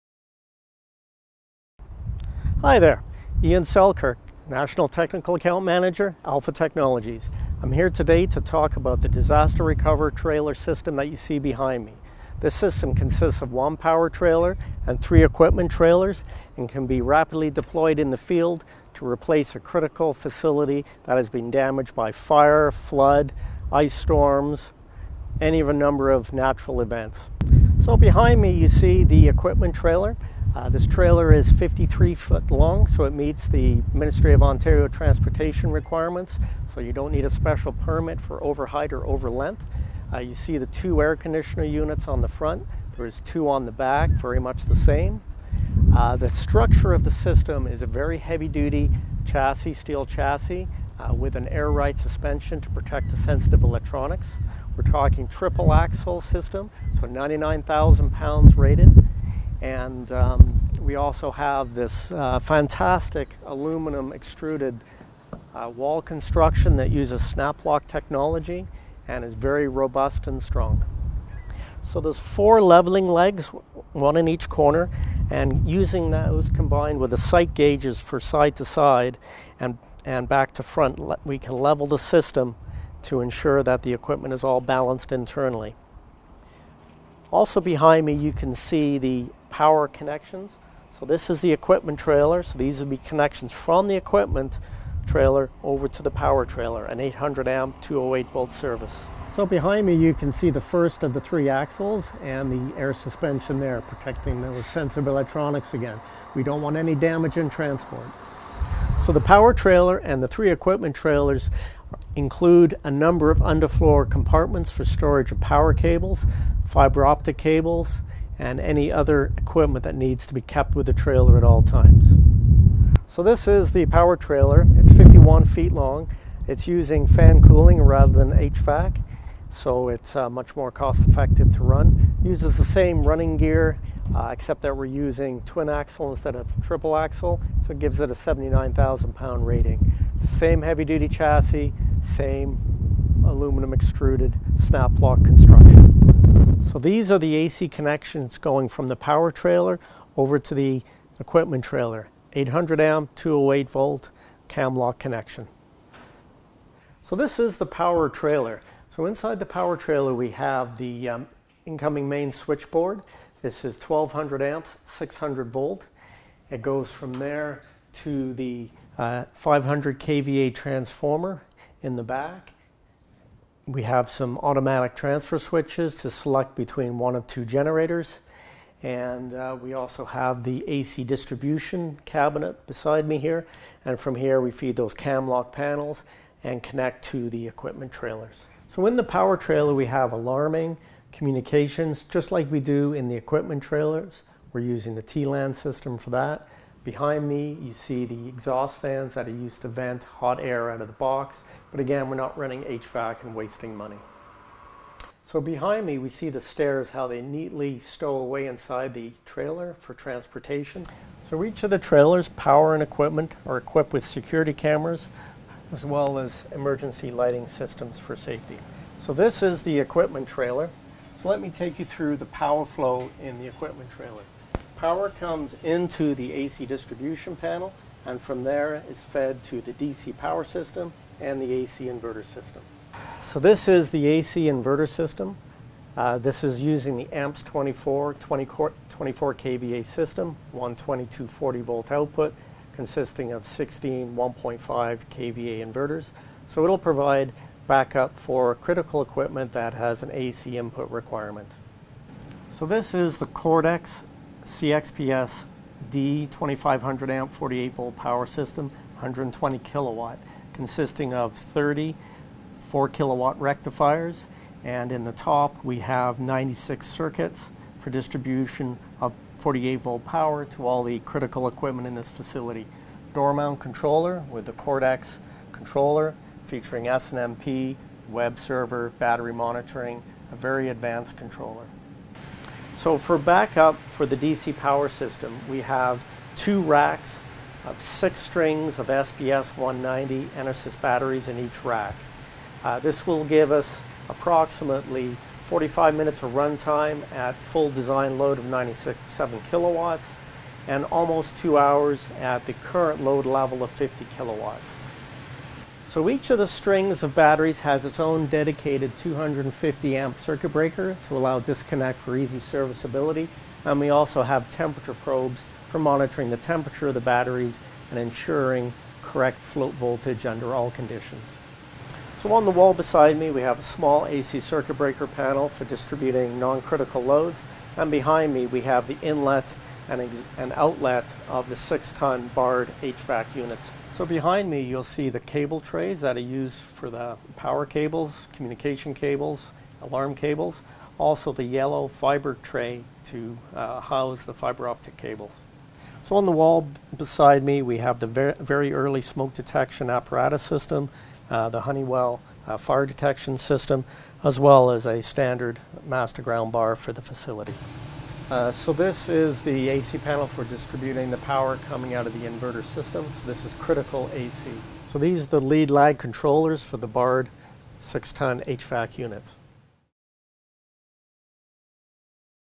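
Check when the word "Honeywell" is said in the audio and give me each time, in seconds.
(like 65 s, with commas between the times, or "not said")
351 s.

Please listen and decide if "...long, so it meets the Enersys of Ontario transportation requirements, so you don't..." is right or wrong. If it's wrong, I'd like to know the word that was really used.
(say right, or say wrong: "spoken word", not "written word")
wrong: "Ministry", not "Enersys".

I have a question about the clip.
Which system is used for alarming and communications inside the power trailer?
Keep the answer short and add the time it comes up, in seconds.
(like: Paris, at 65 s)
TLAN, at 195 s.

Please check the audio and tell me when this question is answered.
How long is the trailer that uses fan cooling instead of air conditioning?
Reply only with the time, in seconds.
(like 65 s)
124 s.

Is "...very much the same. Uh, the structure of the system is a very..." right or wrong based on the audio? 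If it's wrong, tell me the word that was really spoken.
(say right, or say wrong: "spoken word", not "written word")
right.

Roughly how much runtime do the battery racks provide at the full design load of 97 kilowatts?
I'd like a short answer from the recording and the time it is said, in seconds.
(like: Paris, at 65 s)
45 minutes, at 295 s.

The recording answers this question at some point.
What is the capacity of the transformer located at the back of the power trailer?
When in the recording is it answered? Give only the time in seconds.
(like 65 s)
169 s.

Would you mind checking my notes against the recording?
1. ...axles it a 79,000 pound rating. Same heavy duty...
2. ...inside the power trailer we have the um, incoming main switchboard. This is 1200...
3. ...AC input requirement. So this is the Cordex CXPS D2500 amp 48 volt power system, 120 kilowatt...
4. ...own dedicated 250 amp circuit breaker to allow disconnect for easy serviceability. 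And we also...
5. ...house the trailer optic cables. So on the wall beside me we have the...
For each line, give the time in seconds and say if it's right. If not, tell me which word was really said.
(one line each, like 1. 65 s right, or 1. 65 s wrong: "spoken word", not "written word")
1. 137 s wrong: "gives", not "axles"
2. 159 s right
3. 250 s right
4. 307 s right
5. 343 s wrong: "fiber", not "trailer".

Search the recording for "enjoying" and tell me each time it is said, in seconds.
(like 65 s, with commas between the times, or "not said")
not said.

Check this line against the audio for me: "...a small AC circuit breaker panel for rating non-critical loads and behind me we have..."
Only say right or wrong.
wrong.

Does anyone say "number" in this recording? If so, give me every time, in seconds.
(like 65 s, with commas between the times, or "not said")
25 s, 112 s.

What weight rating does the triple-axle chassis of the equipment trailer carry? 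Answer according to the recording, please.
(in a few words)
99,000 pounds.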